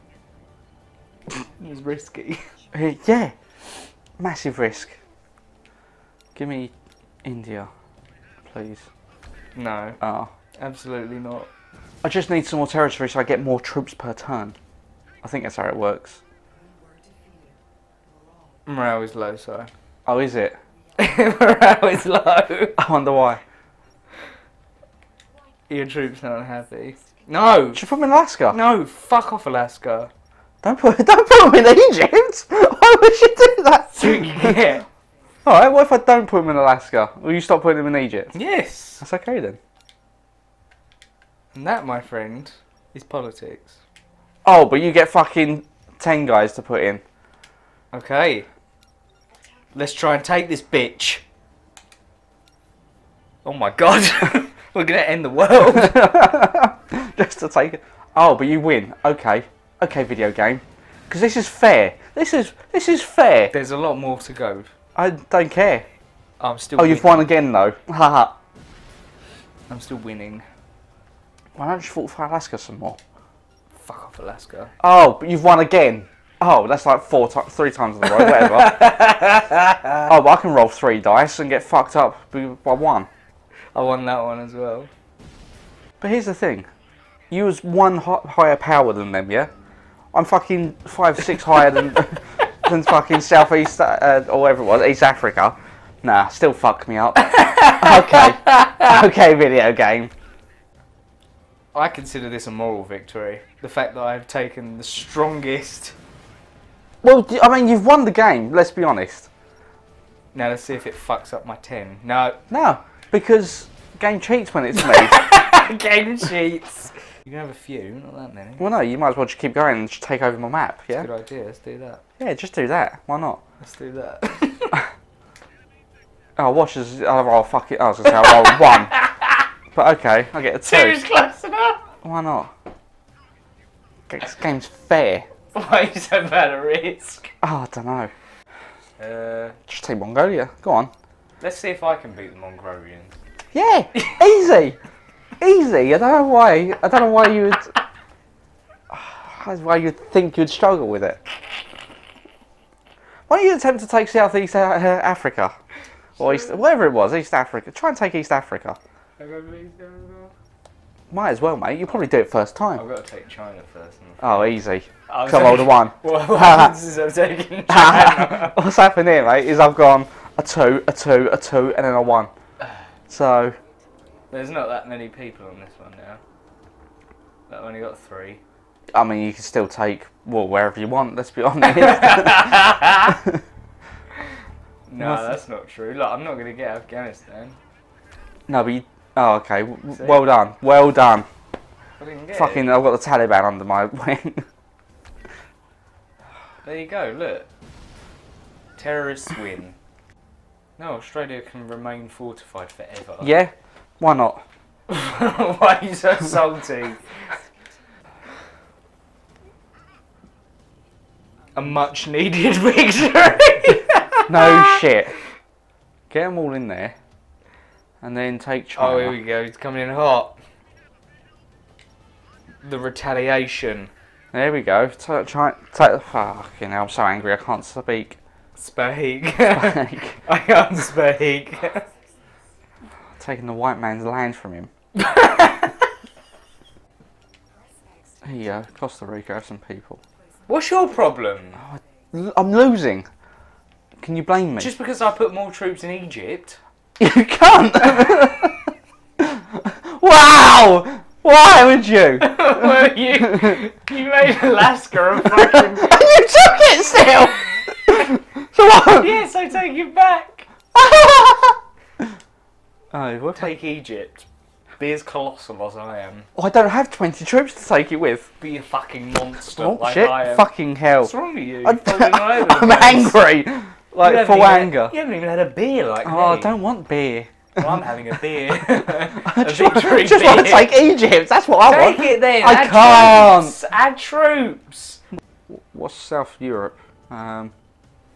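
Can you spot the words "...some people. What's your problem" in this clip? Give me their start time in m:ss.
3:59.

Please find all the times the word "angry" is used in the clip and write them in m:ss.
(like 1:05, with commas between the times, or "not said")
3:47, 4:32.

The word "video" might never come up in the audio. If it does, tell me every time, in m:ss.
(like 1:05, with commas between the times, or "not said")
1:00, 1:39.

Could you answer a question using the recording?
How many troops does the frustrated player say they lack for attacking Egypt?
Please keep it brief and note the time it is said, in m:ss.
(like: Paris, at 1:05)
20, at 4:26.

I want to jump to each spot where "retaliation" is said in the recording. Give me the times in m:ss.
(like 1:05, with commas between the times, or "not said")
3:42.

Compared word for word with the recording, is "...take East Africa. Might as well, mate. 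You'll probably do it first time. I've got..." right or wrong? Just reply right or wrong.
right.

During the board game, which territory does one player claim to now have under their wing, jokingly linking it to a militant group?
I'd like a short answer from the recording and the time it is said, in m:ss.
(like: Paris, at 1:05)
Afghanistan, at 3:06.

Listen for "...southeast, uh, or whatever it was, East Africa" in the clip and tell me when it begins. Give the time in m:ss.
1:33.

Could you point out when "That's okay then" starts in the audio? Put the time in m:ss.
0:38.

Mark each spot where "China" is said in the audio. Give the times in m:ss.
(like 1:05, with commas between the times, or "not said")
2:43, 2:47, 3:38.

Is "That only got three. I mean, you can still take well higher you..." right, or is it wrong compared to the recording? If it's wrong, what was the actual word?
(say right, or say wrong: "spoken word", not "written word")
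wrong: "wherever", not "higher".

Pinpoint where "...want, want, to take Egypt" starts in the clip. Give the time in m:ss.
4:39.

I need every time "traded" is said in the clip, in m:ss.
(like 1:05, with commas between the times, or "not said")
not said.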